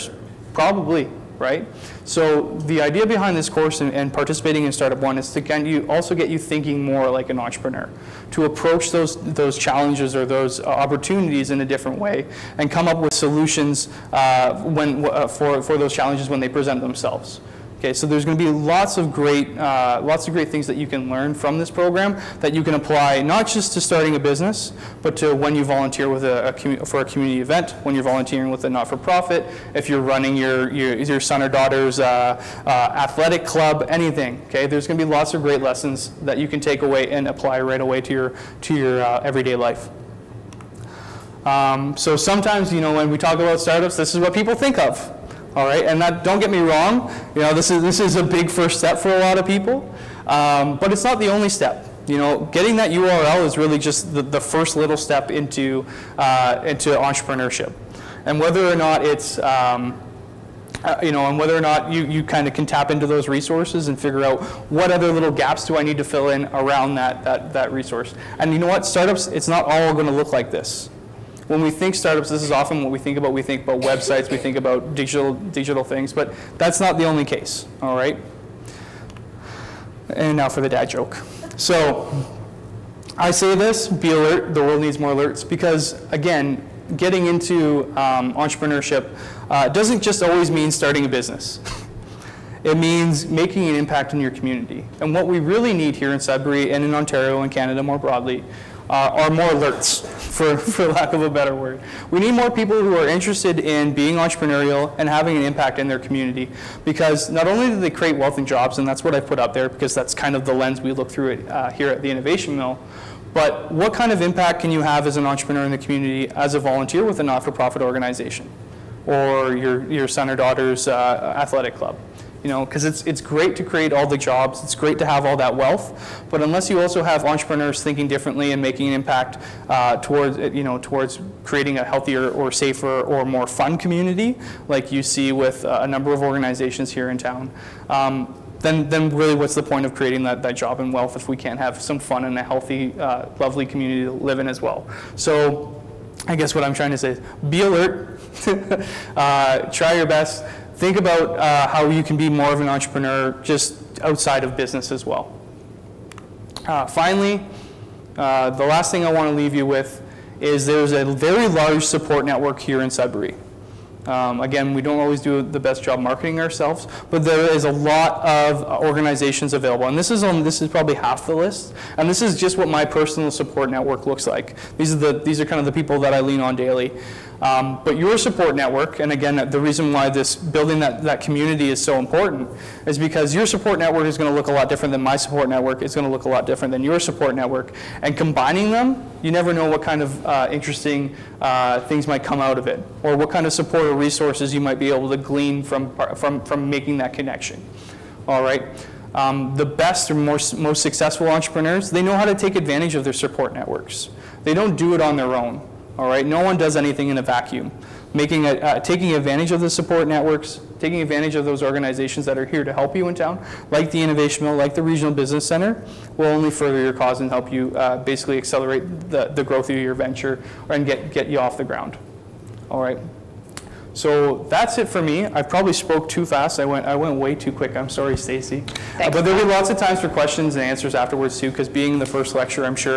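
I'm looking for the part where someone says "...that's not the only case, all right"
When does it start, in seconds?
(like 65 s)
76 s.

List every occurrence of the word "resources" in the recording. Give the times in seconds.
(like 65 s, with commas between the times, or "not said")
63 s, 67 s, 193 s.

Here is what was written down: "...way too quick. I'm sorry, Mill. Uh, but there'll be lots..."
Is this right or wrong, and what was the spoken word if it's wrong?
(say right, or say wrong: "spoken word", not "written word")
wrong: "Stacey", not "Mill".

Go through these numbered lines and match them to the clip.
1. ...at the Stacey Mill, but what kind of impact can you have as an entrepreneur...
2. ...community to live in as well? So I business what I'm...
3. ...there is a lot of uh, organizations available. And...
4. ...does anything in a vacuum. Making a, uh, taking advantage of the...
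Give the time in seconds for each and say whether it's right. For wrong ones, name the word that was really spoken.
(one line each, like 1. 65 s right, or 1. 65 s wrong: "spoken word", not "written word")
1. 111 s wrong: "Innovation", not "Stacey"
2. 143 s wrong: "guess", not "business"
3. 167 s right
4. 206 s right.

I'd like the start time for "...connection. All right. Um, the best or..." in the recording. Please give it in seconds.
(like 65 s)
197 s.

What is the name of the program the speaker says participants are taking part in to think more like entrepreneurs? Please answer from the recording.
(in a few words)
Startup One.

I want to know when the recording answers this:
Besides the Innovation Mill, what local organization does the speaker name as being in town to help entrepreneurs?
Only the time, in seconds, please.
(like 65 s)
214 s.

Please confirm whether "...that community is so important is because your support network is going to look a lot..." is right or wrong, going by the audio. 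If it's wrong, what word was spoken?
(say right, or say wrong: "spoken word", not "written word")
right.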